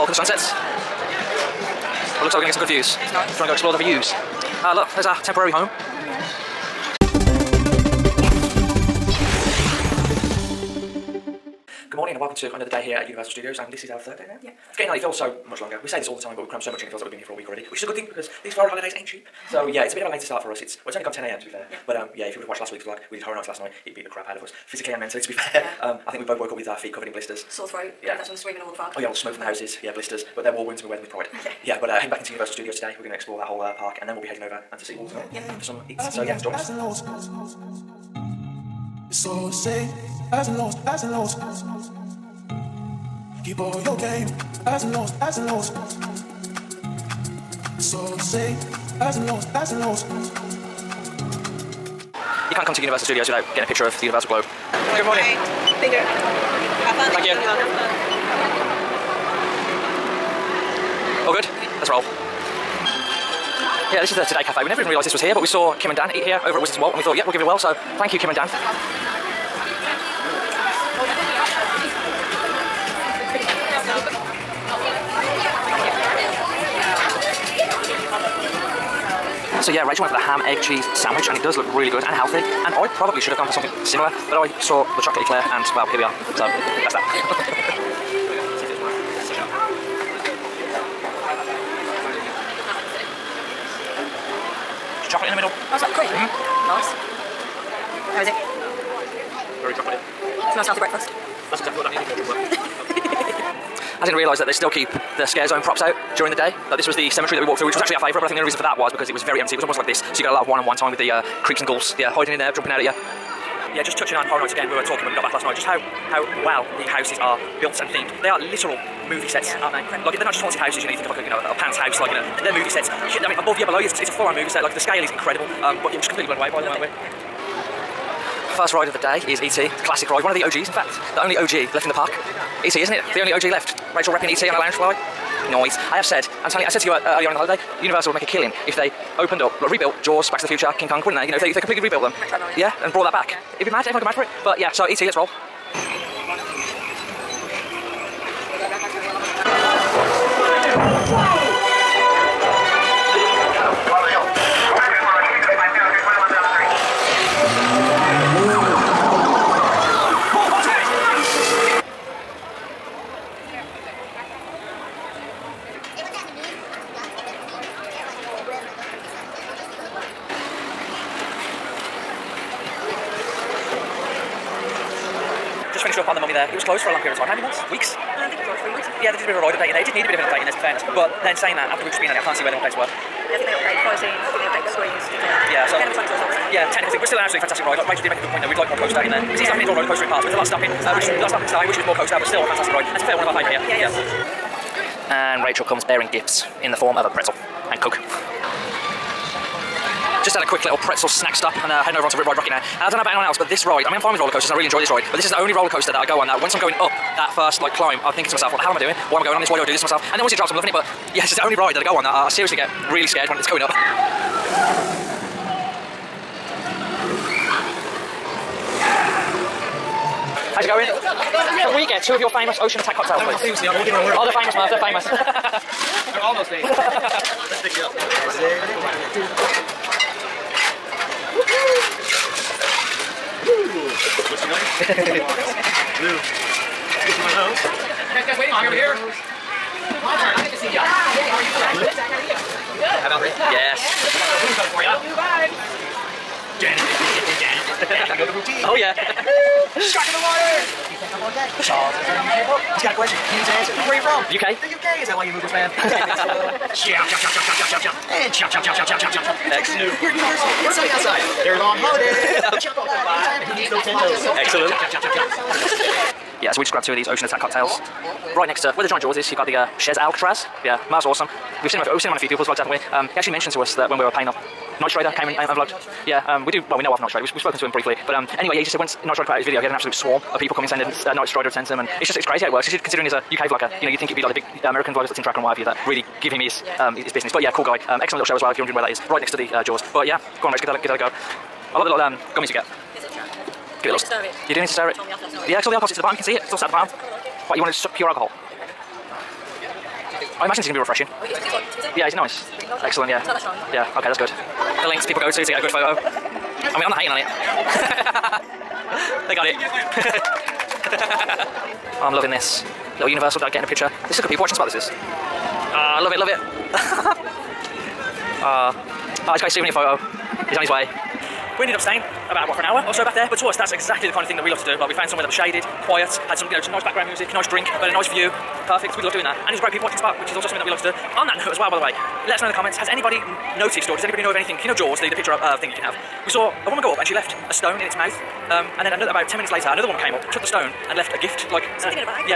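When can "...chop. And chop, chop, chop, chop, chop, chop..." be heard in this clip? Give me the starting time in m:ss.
4:17.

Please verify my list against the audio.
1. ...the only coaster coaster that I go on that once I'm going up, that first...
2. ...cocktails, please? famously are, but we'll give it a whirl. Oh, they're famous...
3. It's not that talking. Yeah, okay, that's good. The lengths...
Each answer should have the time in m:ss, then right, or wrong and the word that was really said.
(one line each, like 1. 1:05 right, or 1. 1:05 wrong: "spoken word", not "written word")
1. 3:25 wrong: "roller", not "coaster"
2. 3:42 right
3. 5:03 wrong: "strong", not "talking".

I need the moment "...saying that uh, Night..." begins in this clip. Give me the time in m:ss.
4:40.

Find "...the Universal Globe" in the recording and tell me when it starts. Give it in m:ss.
0:54.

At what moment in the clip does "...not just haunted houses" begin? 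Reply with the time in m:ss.
2:00.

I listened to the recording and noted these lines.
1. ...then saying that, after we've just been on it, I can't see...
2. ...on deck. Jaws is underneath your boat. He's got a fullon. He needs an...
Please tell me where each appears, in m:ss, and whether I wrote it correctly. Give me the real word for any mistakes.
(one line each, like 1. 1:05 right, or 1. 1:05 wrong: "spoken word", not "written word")
1. 3:01 right
2. 4:11 wrong: "question", not "fullon".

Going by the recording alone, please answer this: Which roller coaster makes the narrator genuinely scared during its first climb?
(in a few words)
Rip Ride Rockit.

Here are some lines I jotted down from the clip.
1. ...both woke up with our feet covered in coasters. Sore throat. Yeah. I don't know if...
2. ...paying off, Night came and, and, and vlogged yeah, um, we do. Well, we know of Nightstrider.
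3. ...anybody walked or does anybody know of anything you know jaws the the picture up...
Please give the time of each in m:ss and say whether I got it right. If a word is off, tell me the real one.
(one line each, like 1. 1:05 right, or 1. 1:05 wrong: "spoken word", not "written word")
1. 0:26 wrong: "blisters", not "coasters"
2. 4:34 right
3. 5:32 wrong: "noticed", not "walked".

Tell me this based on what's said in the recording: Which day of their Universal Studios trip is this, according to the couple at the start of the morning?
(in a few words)
Third day.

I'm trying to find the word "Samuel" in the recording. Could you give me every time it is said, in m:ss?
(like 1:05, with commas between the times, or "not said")
not said.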